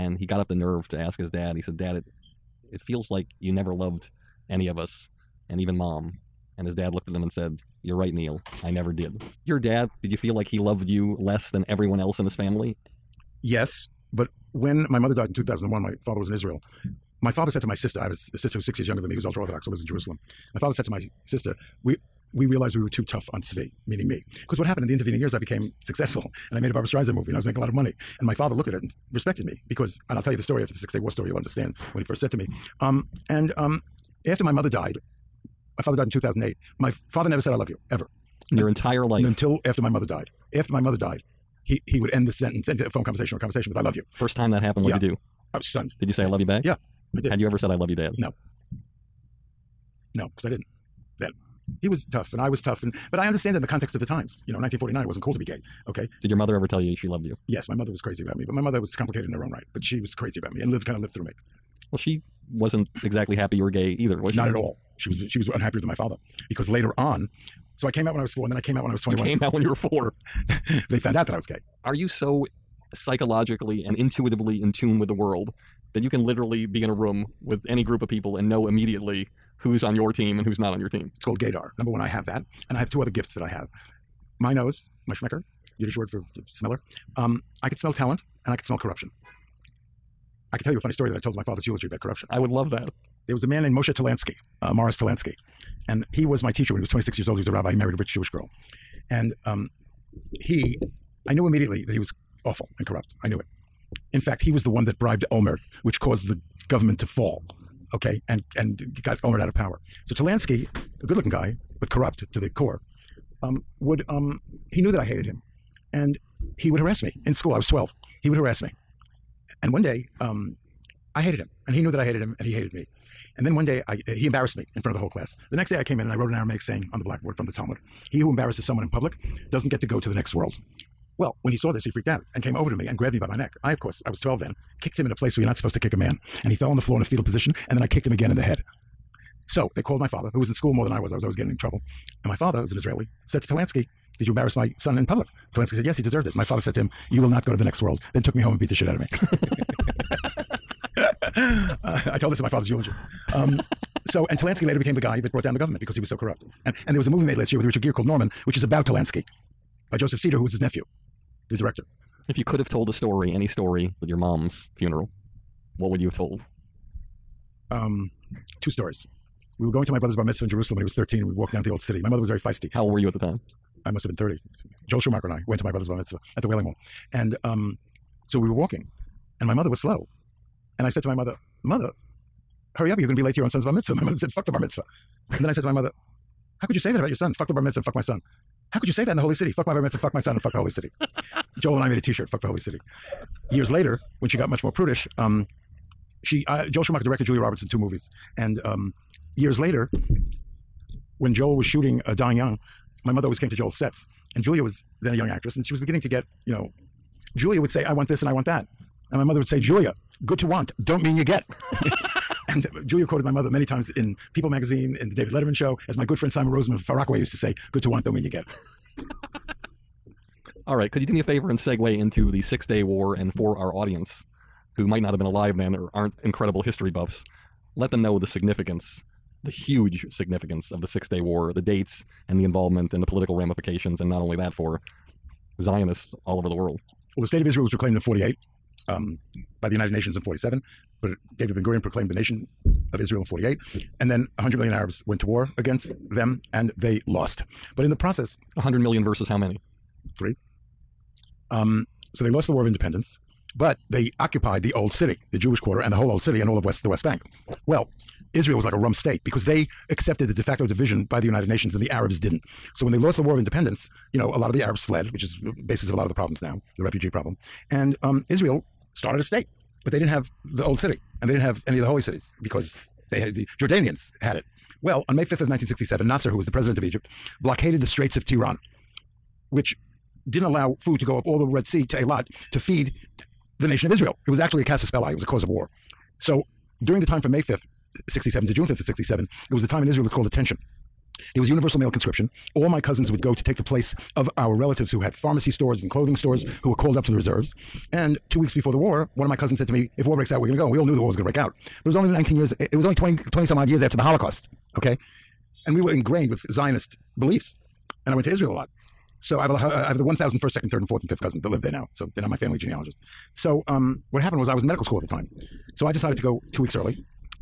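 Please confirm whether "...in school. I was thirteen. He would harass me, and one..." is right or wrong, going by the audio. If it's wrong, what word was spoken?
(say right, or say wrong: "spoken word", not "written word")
wrong: "twelve", not "thirteen".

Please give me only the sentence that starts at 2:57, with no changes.
And um, so we were walking, and my mother was slow.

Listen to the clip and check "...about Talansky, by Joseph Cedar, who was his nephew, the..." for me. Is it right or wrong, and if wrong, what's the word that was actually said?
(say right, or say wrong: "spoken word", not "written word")
right.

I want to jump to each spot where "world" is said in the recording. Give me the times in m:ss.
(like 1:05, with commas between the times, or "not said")
1:15, 2:10, 2:27, 3:56.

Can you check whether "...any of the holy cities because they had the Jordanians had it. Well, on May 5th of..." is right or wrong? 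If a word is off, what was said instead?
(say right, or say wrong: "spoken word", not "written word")
right.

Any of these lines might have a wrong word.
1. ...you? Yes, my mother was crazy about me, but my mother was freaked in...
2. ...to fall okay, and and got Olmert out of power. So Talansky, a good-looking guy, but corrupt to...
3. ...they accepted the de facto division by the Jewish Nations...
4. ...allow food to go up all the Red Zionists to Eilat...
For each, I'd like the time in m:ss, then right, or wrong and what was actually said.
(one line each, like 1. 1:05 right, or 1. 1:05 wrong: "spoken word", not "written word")
1. 0:57 wrong: "complicated", not "freaked"
2. 1:47 right
3. 4:19 wrong: "United", not "Jewish"
4. 4:40 wrong: "Sea", not "Zionists".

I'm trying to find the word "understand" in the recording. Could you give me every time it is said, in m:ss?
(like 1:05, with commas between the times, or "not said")
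0:31, 0:53.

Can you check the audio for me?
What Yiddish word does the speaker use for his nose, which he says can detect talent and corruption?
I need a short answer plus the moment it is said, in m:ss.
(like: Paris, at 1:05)
Schmecker, at 1:25.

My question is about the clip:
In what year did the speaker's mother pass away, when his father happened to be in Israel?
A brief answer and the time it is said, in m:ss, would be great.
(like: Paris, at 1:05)
2001, at 0:15.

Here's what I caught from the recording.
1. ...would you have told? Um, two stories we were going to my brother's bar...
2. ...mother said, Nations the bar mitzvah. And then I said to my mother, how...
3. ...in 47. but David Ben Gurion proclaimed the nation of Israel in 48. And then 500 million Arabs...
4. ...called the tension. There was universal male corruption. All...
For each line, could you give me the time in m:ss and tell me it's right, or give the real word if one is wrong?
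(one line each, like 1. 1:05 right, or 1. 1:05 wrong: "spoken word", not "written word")
1. 2:45 right
2. 3:04 wrong: "Fuck", not "Nations"
3. 4:00 wrong: "100", not "500"
4. 4:50 wrong: "conscription", not "corruption".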